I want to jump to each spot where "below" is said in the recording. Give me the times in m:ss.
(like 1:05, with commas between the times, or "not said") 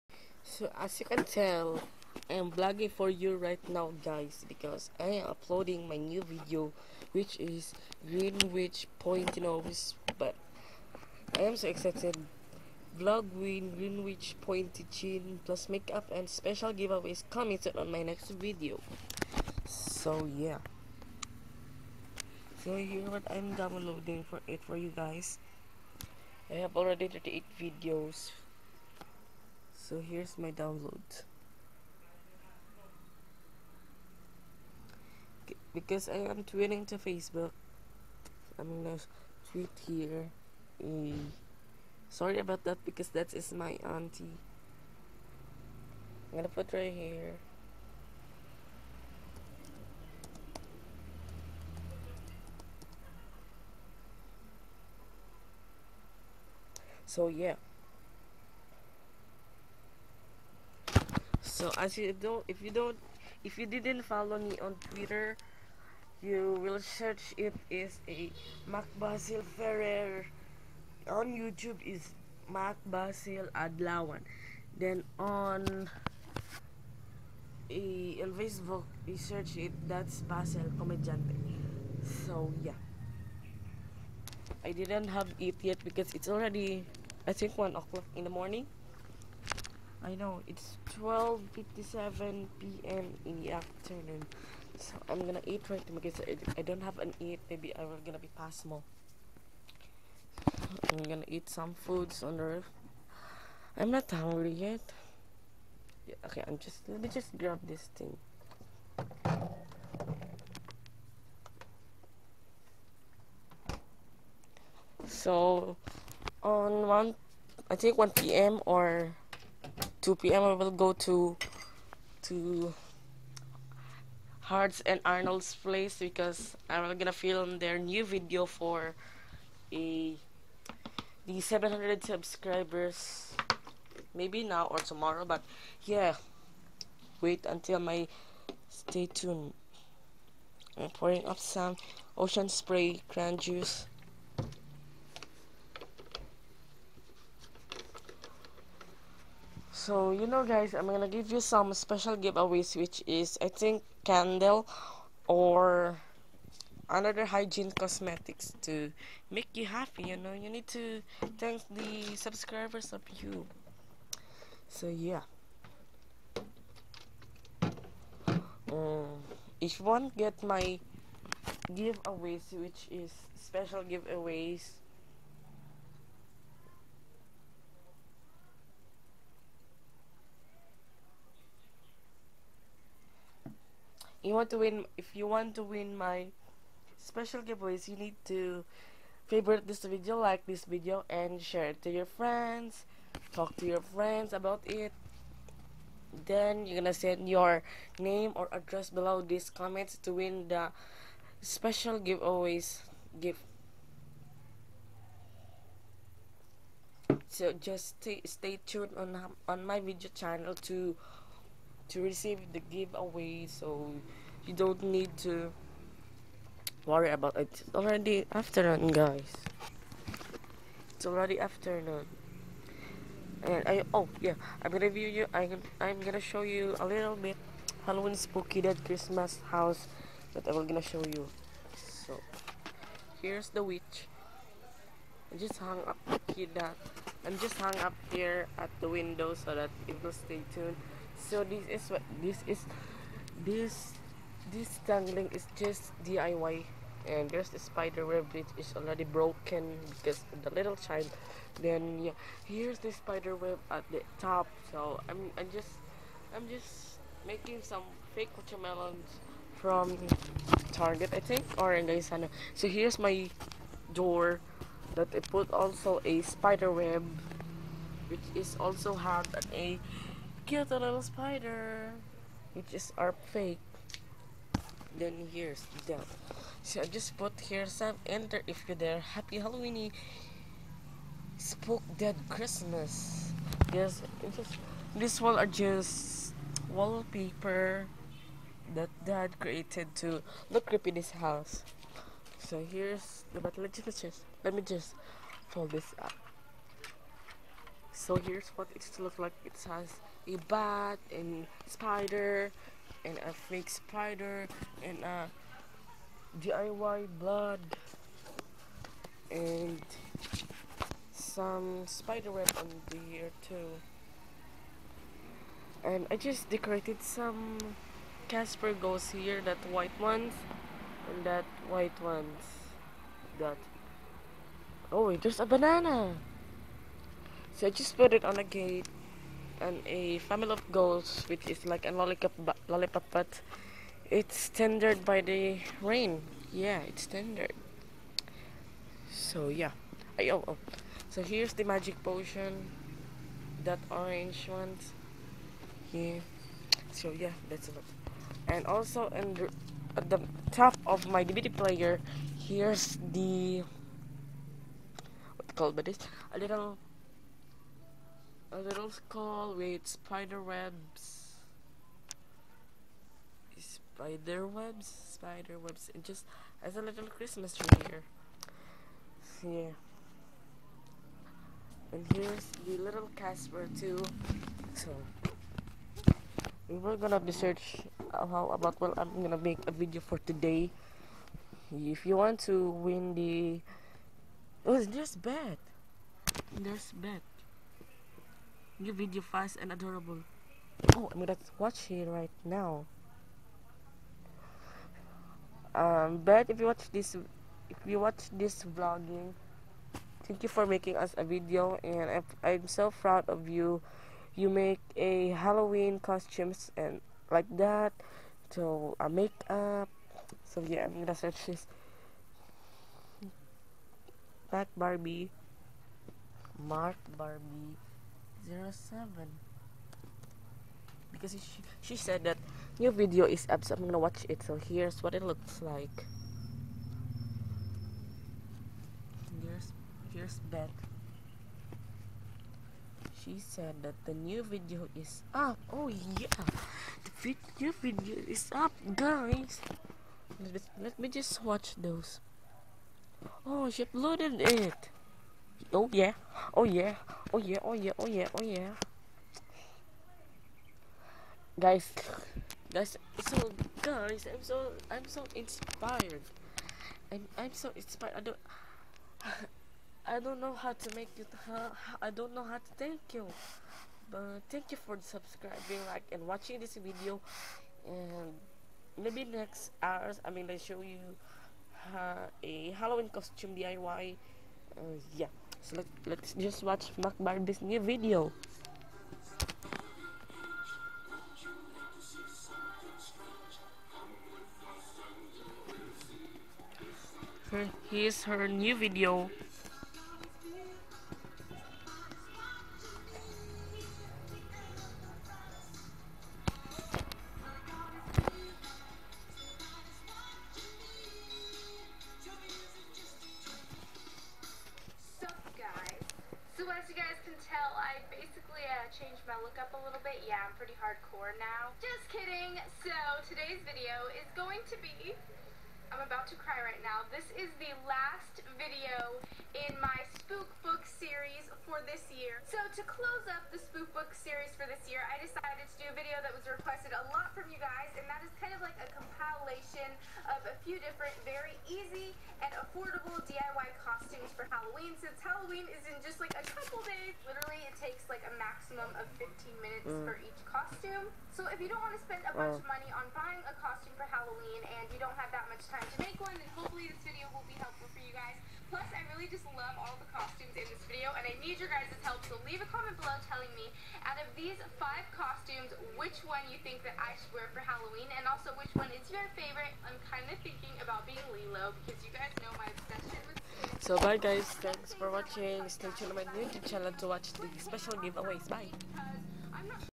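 3:18, 9:13.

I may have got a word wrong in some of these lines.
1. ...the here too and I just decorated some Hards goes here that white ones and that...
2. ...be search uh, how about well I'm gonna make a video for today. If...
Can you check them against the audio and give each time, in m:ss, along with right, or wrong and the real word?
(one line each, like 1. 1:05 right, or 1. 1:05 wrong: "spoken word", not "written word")
1. 5:12 wrong: "Casper", not "Hards"
2. 6:17 right.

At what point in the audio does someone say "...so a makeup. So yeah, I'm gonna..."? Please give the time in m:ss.
6:48.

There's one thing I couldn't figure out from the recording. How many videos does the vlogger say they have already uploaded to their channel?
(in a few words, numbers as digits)
38.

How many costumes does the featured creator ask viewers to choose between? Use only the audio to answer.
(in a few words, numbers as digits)
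5.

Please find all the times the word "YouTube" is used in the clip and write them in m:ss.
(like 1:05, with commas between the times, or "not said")
1:11, 9:26.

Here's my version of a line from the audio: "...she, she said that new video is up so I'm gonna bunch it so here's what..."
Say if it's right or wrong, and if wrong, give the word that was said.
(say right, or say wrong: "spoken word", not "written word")
wrong: "watch", not "bunch".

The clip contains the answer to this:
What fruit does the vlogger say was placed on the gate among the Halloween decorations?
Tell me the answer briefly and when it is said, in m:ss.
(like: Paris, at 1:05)
banana, at 5:25.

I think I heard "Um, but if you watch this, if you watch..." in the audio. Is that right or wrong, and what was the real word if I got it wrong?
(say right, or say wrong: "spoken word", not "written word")
right.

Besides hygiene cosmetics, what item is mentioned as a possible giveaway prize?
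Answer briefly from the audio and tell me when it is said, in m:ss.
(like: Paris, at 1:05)
candle, at 2:34.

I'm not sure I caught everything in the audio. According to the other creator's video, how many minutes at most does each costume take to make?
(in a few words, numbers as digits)
15.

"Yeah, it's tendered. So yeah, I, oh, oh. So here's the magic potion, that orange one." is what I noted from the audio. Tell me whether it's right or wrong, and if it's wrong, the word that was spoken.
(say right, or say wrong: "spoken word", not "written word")
right.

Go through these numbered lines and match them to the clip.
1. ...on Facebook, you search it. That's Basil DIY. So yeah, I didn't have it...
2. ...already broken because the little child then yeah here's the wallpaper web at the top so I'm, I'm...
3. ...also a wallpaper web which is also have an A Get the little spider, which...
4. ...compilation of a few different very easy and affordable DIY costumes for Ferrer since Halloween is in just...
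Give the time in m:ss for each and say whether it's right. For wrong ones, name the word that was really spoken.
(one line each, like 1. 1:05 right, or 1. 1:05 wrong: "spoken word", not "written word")
1. 1:18 wrong: "Comediante", not "DIY"
2. 4:08 wrong: "spider", not "wallpaper"
3. 4:25 wrong: "spider", not "wallpaper"
4. 8:48 wrong: "Halloween", not "Ferrer".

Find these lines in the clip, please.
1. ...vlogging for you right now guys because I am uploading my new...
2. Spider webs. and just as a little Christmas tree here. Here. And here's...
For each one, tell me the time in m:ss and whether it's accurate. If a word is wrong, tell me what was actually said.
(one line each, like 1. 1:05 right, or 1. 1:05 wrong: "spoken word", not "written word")
1. 0:02 right
2. 6:05 right.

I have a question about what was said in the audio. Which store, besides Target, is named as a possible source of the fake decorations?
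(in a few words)
Gaisano.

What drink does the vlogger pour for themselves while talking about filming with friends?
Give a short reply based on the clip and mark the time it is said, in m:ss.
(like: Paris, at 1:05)
Ocean Spray cran juice, at 2:22.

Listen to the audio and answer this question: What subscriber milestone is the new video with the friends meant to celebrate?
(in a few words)
700.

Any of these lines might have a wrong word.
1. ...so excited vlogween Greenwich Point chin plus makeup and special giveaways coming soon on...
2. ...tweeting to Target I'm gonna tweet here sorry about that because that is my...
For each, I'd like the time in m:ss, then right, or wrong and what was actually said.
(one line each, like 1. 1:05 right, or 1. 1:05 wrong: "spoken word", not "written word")
1. 0:11 right
2. 0:36 wrong: "Facebook", not "Target".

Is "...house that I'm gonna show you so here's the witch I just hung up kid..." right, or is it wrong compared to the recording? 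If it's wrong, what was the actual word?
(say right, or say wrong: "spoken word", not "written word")
right.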